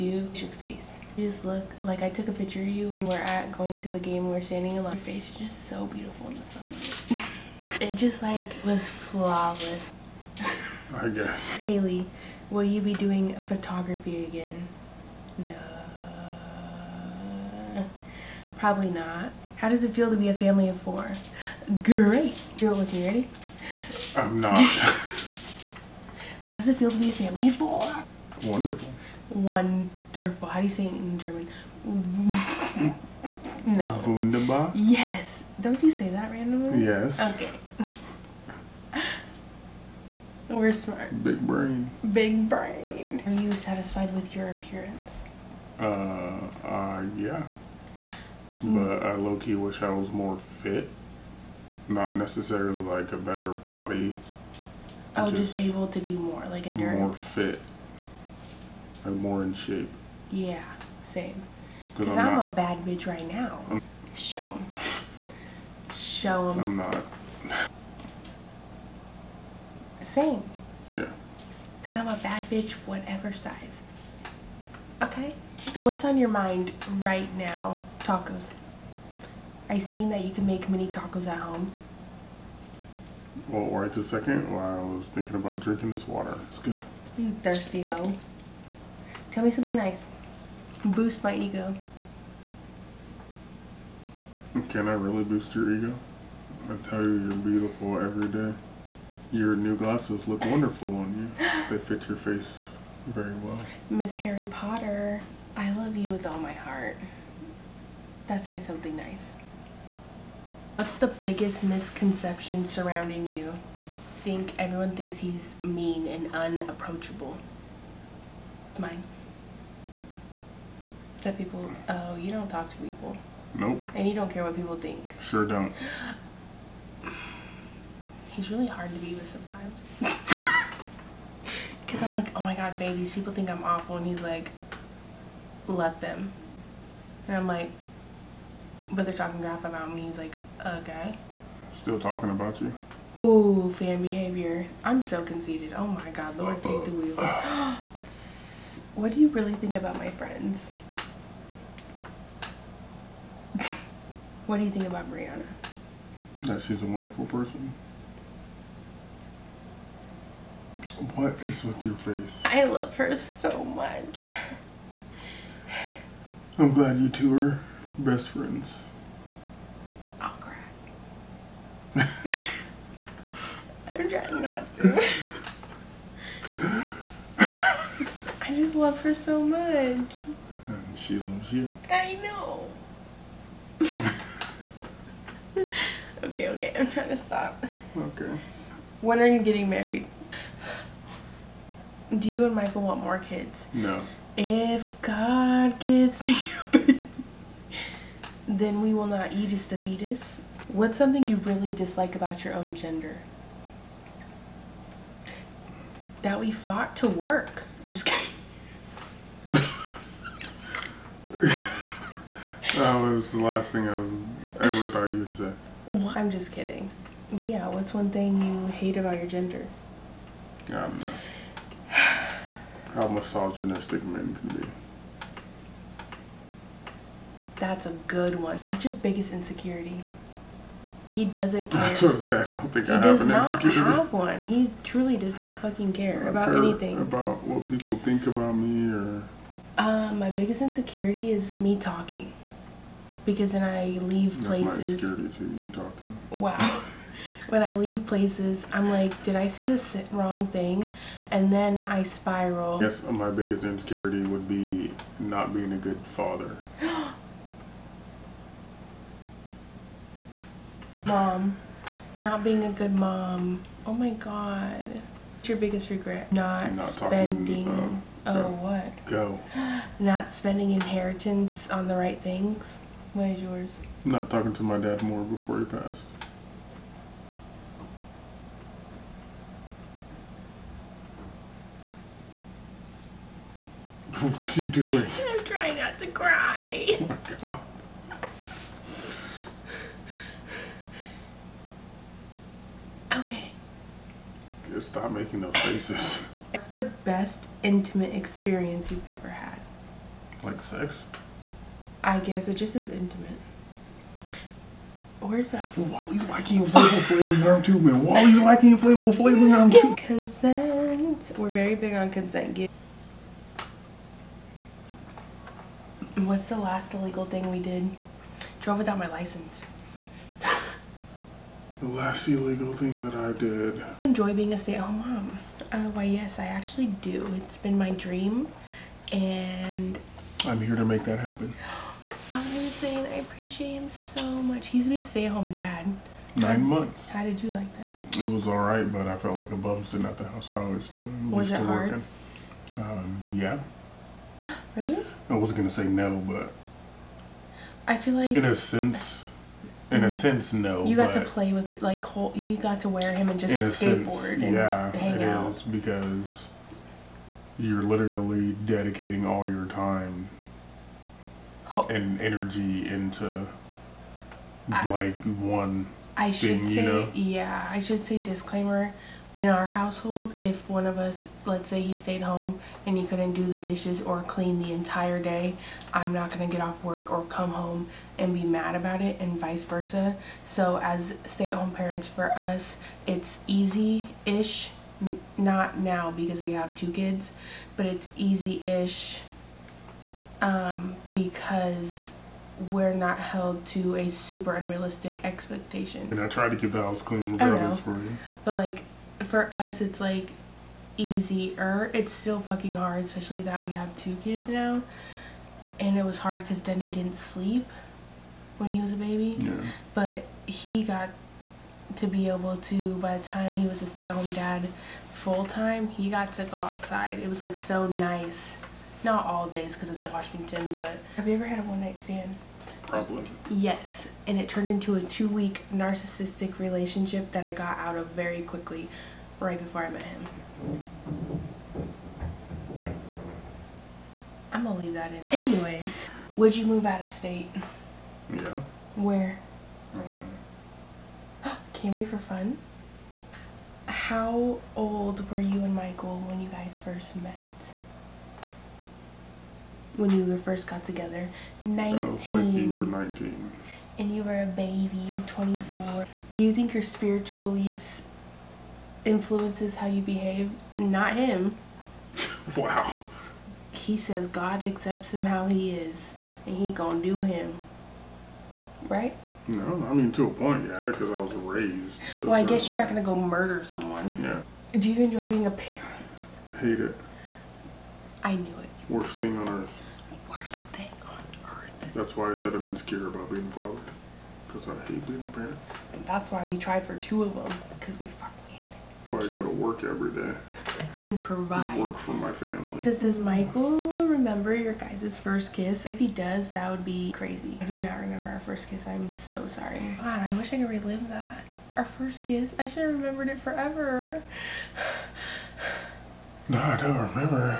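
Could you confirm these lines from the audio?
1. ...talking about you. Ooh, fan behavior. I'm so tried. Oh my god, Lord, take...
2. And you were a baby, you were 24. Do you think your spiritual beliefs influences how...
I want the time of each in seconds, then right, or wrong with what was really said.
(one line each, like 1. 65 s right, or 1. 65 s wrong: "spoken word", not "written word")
1. 141 s wrong: "conceited", not "tried"
2. 453 s right.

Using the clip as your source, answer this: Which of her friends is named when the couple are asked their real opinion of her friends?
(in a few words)
Brianna.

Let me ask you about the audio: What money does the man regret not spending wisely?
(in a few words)
Inheritance.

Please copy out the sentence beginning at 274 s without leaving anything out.
Not talking to my dad more before he passed.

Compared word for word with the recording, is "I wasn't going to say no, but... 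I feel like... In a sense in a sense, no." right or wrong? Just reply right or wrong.
right.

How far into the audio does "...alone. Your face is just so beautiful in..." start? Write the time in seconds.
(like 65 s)
4 s.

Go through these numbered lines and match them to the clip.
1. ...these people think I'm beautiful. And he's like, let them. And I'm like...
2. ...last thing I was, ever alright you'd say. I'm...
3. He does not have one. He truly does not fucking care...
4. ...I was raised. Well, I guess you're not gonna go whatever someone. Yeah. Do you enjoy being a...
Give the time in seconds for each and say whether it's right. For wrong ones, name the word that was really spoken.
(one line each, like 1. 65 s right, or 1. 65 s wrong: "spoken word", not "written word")
1. 132 s wrong: "awful", not "beautiful"
2. 213 s wrong: "thought", not "alright"
3. 233 s right
4. 471 s wrong: "murder", not "whatever".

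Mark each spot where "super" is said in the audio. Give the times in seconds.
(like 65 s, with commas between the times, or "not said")
394 s.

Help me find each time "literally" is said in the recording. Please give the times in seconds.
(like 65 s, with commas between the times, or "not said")
357 s.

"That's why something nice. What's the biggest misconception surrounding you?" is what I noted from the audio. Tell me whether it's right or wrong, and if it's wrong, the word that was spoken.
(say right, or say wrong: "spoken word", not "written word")
right.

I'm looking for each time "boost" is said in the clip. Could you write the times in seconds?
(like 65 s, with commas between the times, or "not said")
90 s, 95 s.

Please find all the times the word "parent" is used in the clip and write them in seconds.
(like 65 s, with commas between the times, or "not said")
381 s, 475 s, 485 s.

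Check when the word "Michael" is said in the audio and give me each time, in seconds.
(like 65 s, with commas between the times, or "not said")
192 s, 445 s, 493 s.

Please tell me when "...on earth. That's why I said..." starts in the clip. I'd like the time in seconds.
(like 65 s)
479 s.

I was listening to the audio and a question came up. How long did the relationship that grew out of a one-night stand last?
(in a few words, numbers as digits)
2 weeks.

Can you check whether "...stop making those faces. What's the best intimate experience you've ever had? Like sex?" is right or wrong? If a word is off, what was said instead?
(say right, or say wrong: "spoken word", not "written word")
right.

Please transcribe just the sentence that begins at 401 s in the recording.
It's still fucking hard, especially that we have two kids now.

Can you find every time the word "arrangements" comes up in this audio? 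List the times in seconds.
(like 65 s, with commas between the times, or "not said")
not said.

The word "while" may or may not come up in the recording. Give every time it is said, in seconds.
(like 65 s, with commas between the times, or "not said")
84 s.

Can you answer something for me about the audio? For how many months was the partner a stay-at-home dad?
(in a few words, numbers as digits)
9.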